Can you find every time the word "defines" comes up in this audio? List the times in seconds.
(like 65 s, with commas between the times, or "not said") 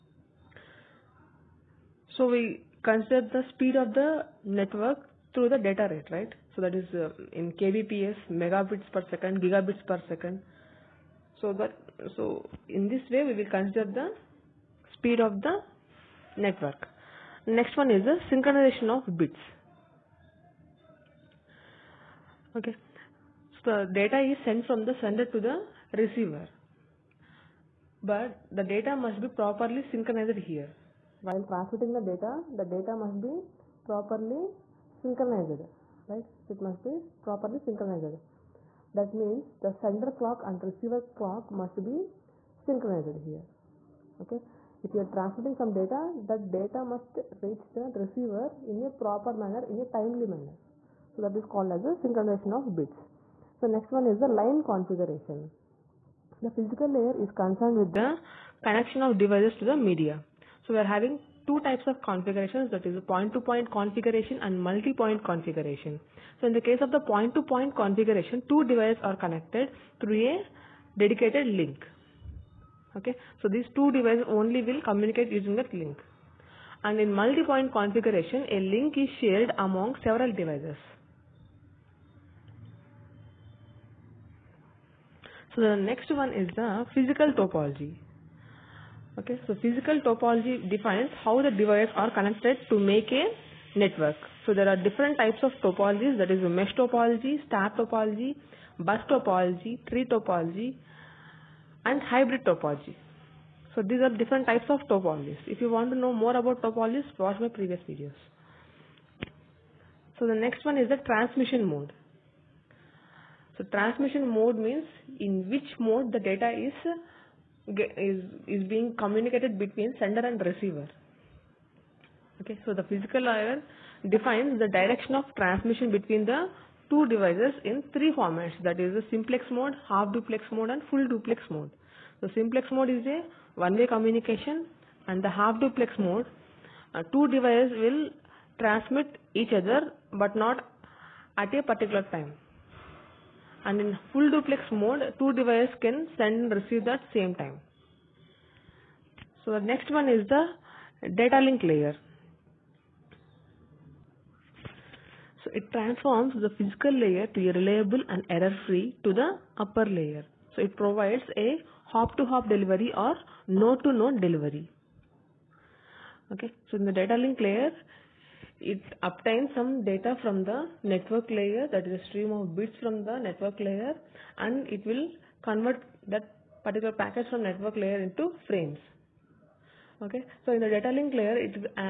90 s, 124 s.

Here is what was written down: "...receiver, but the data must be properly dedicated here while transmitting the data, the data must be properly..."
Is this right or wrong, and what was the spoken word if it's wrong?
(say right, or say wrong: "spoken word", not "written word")
wrong: "synchronized", not "dedicated".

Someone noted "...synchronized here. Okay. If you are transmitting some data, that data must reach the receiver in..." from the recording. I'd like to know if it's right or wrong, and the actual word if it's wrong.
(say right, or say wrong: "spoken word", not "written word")
right.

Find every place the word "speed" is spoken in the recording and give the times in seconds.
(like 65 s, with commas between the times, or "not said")
3 s, 14 s.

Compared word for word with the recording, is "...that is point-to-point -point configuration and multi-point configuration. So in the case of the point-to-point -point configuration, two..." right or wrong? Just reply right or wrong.
right.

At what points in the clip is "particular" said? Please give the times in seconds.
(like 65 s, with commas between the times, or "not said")
141 s, 176 s.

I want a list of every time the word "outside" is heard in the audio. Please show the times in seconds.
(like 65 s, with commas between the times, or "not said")
not said.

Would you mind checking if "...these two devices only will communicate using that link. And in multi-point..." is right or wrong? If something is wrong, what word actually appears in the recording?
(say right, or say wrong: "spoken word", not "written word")
right.